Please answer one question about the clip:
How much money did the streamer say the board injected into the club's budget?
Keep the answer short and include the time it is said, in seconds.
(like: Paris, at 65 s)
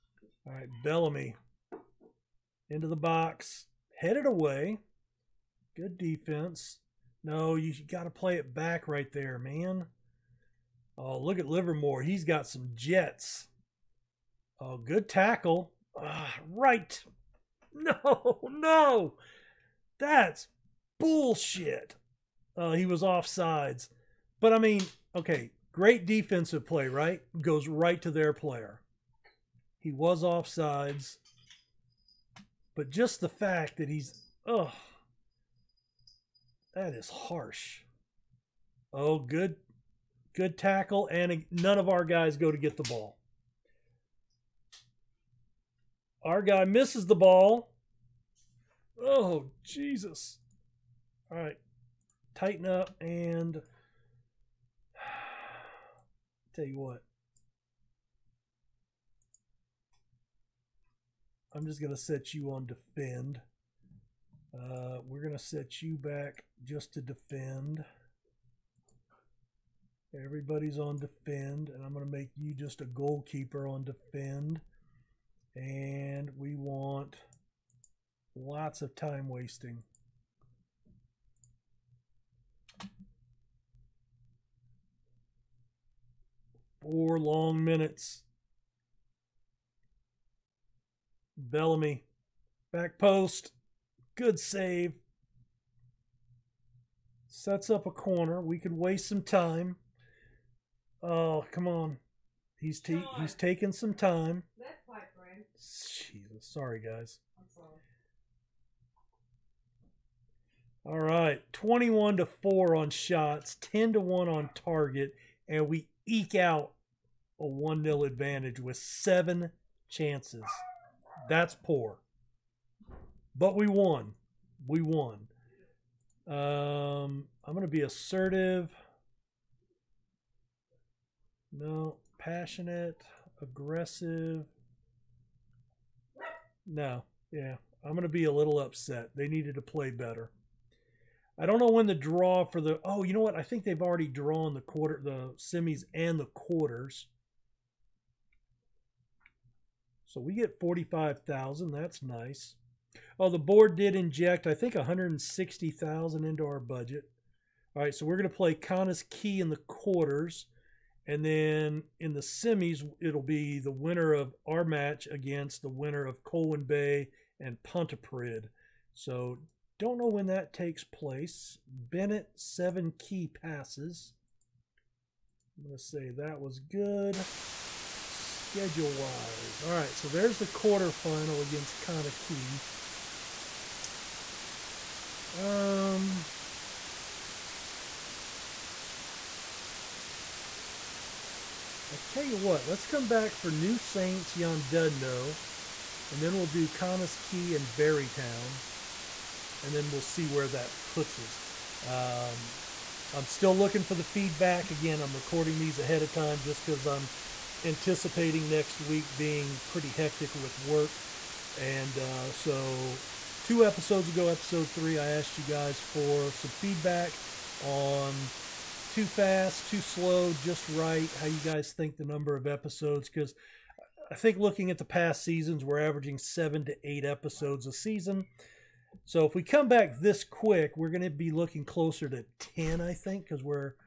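160,000, at 154 s.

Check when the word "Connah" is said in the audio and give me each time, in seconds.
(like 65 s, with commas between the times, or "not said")
158 s, 181 s, 196 s.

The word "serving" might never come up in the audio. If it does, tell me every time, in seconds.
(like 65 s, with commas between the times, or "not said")
not said.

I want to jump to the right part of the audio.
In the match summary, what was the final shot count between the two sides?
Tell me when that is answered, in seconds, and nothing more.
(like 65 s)
111 s.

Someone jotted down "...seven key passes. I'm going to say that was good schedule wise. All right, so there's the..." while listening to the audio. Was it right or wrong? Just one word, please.
right.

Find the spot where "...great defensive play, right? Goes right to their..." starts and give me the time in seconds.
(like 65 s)
25 s.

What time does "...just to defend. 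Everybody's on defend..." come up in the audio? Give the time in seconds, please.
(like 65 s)
66 s.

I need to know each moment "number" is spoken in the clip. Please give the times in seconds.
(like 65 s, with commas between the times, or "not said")
222 s.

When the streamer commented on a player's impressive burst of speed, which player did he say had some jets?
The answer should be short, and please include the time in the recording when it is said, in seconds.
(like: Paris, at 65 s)
Livermore, at 11 s.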